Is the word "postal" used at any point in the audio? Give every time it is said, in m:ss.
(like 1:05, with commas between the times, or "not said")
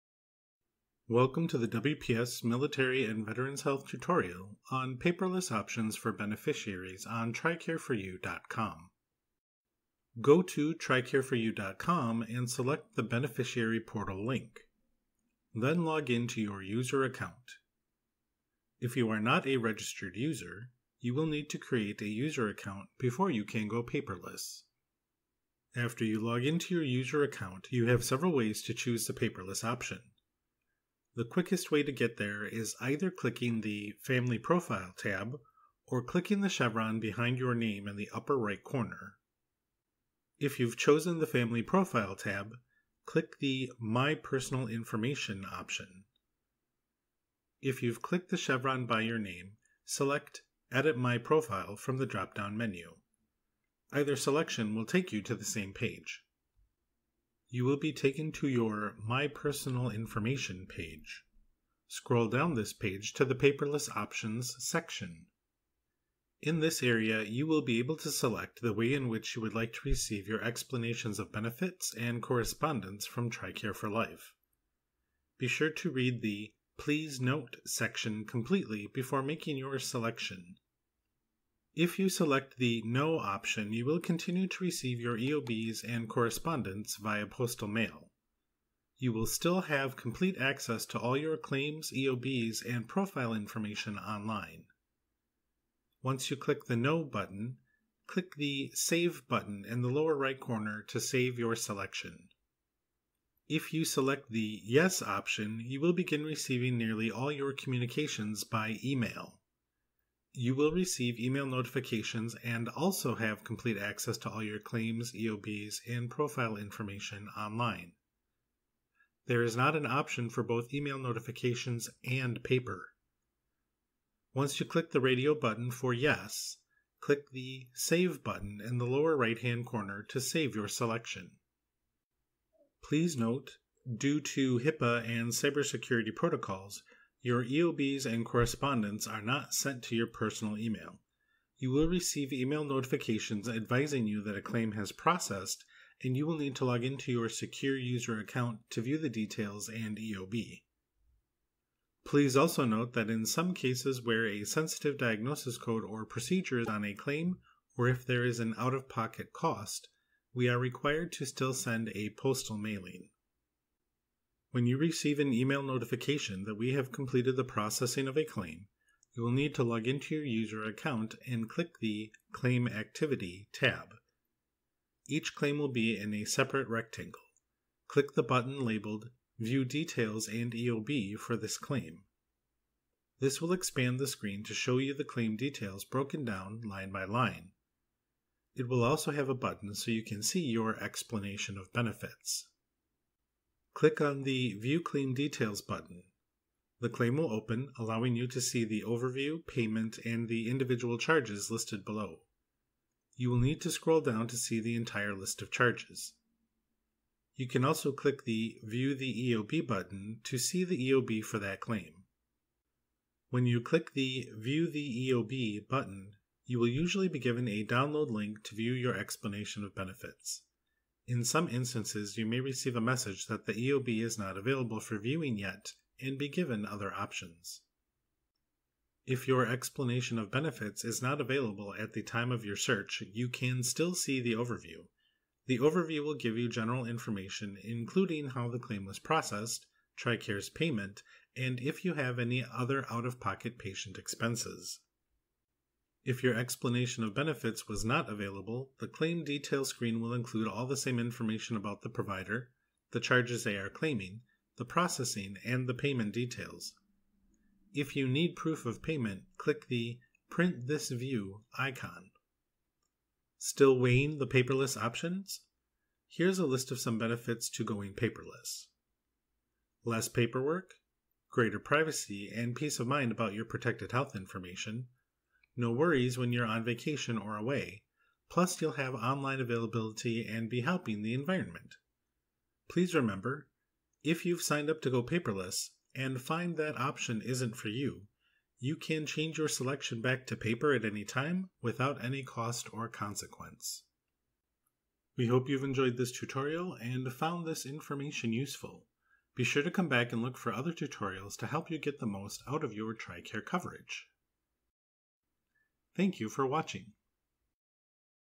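1:27, 2:42.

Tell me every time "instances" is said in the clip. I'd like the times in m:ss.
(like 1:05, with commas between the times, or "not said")
3:41.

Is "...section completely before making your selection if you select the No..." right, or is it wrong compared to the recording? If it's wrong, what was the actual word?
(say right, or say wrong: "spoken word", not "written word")
right.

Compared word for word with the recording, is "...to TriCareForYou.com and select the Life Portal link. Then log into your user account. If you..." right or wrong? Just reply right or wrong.
wrong.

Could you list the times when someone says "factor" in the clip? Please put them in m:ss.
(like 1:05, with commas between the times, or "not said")
not said.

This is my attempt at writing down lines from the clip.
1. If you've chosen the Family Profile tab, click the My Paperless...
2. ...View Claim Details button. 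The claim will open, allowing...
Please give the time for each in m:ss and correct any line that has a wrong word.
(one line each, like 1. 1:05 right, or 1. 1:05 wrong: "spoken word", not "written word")
1. 0:40 wrong: "Personal", not "Paperless"
2. 3:14 right.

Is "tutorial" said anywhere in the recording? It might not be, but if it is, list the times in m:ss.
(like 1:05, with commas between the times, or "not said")
0:03, 4:56, 5:00.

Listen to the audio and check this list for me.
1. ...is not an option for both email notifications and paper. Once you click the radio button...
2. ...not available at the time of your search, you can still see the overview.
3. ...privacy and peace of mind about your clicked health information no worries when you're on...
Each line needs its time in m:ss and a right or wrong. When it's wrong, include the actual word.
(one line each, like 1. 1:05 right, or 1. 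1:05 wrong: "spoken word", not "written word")
1. 1:59 right
2. 3:51 right
3. 4:31 wrong: "protected", not "clicked".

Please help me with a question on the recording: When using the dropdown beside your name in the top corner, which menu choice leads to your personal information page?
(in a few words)
Edit My Profile.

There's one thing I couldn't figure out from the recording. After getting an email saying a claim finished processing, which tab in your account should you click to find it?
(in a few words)
Claim Activity.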